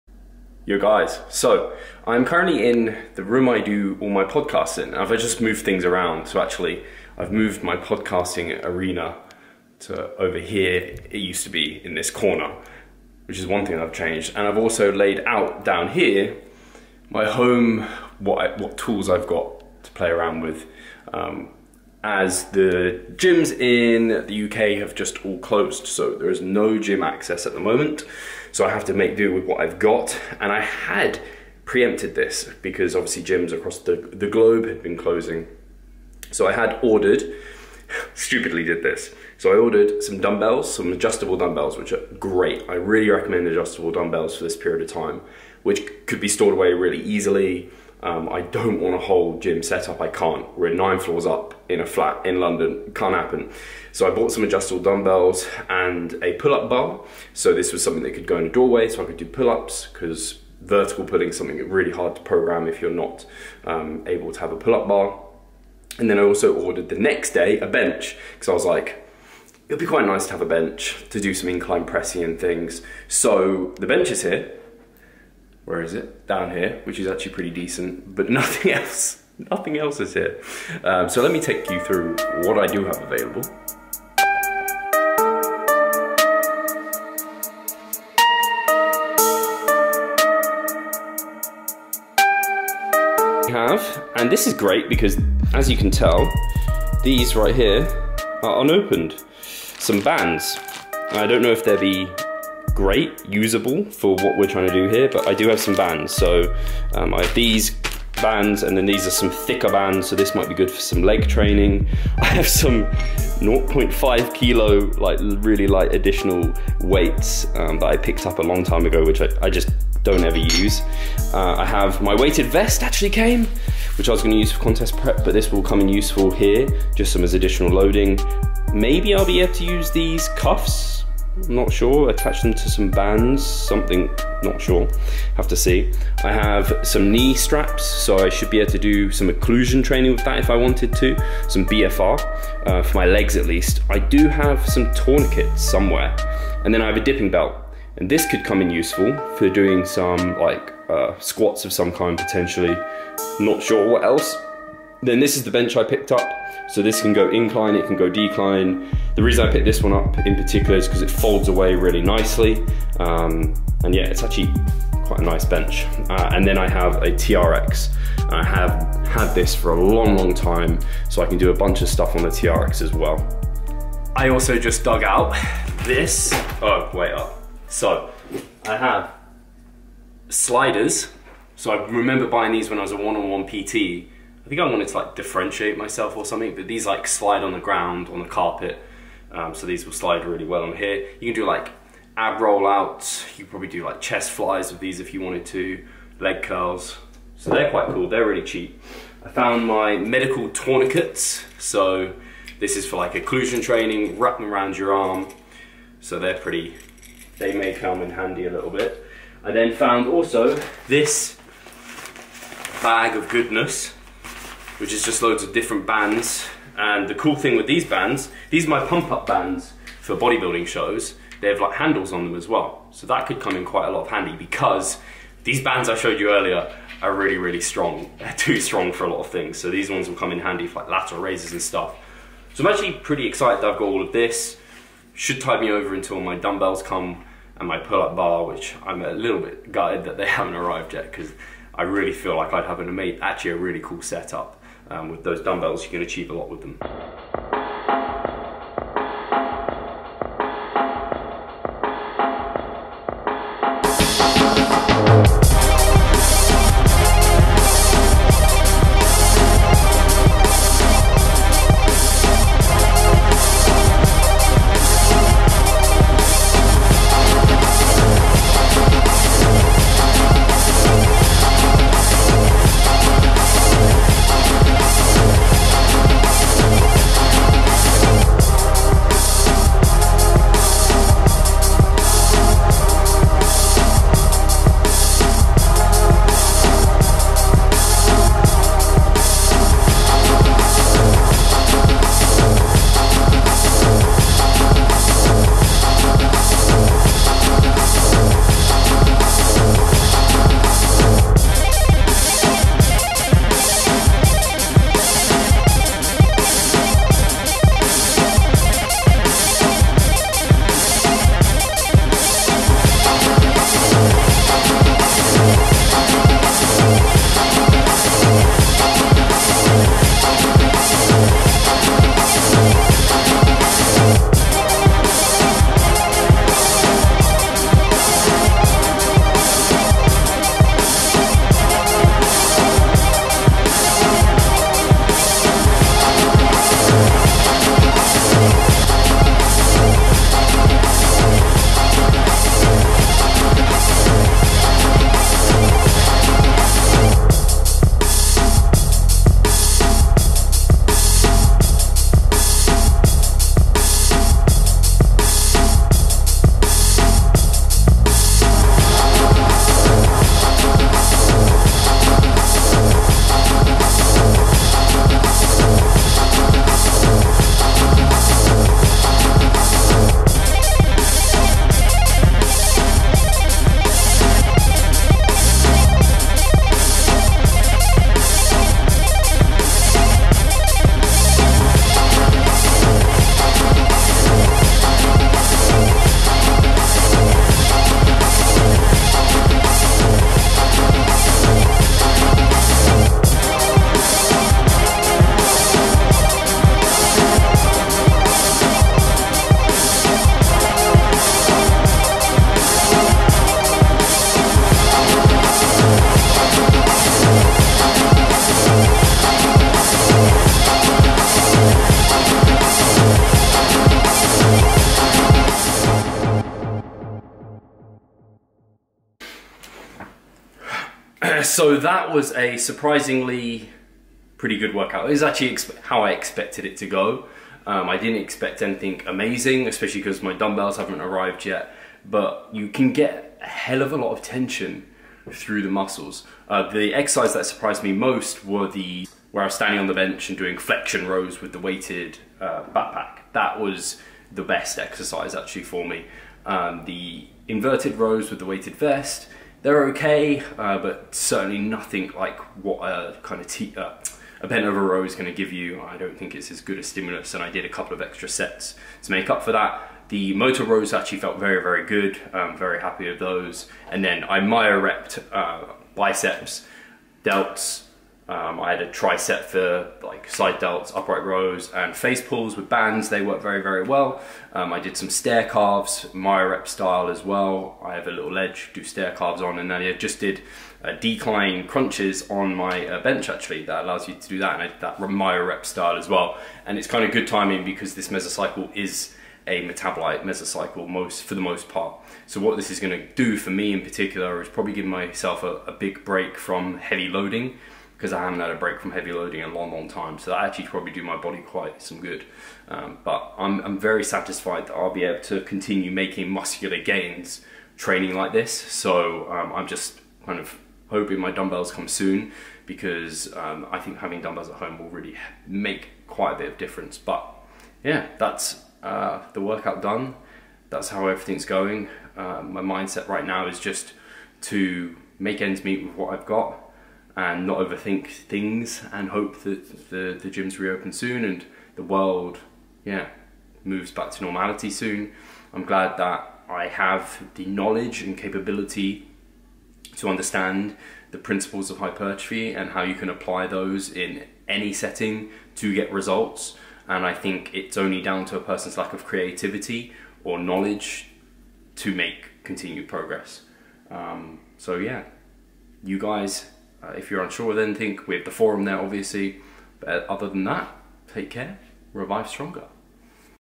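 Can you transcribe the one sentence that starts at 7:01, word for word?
so that was a surprisingly pretty good workout.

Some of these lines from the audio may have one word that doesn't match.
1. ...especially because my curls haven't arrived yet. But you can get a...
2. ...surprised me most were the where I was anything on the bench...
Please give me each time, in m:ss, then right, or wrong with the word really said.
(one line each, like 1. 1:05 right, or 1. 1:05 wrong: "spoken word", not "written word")
1. 7:09 wrong: "dumbbells", not "curls"
2. 7:17 wrong: "standing", not "anything".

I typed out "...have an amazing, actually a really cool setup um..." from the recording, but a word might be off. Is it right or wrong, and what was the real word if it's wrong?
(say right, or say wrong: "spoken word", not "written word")
right.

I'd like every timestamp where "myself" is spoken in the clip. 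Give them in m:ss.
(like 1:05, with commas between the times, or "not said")
3:05, 8:14.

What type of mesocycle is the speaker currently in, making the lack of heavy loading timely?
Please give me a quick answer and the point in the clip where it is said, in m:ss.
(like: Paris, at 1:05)
Metabolite mesocycle, at 8:09.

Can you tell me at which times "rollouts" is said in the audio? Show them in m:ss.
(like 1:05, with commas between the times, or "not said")
3:12.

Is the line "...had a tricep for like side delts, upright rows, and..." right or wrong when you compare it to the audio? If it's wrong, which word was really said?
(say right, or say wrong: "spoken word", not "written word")
right.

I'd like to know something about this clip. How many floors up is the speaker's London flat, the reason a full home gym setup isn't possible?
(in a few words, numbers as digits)
9.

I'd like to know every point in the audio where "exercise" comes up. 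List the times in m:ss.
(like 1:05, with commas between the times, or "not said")
7:16, 7:24.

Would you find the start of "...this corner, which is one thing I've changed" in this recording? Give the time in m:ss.
0:11.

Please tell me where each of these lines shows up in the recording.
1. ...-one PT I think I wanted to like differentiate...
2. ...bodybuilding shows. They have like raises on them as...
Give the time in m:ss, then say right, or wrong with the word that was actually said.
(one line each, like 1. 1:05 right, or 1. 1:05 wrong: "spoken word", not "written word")
1. 3:03 right
2. 3:40 wrong: "handles", not "raises".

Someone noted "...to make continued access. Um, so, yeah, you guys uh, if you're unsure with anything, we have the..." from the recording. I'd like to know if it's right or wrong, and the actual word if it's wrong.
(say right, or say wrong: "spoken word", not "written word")
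wrong: "progress", not "access".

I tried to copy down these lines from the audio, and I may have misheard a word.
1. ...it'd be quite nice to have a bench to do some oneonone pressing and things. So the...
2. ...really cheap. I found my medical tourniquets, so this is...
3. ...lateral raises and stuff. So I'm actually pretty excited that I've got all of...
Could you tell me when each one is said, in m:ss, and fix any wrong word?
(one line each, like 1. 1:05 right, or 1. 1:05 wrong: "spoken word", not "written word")
1. 1:09 wrong: "incline", not "oneonone"
2. 3:18 right
3. 3:50 right.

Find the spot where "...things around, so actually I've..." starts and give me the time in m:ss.
0:05.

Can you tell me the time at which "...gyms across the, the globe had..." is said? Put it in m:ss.
0:33.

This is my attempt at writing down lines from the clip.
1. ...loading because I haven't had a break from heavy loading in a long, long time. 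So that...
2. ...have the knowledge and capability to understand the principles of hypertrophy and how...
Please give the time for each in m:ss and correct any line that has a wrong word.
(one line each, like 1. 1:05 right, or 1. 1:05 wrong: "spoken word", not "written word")
1. 8:17 right
2. 8:56 right.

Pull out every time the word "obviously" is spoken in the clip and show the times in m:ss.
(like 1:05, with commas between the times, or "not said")
0:32, 9:18.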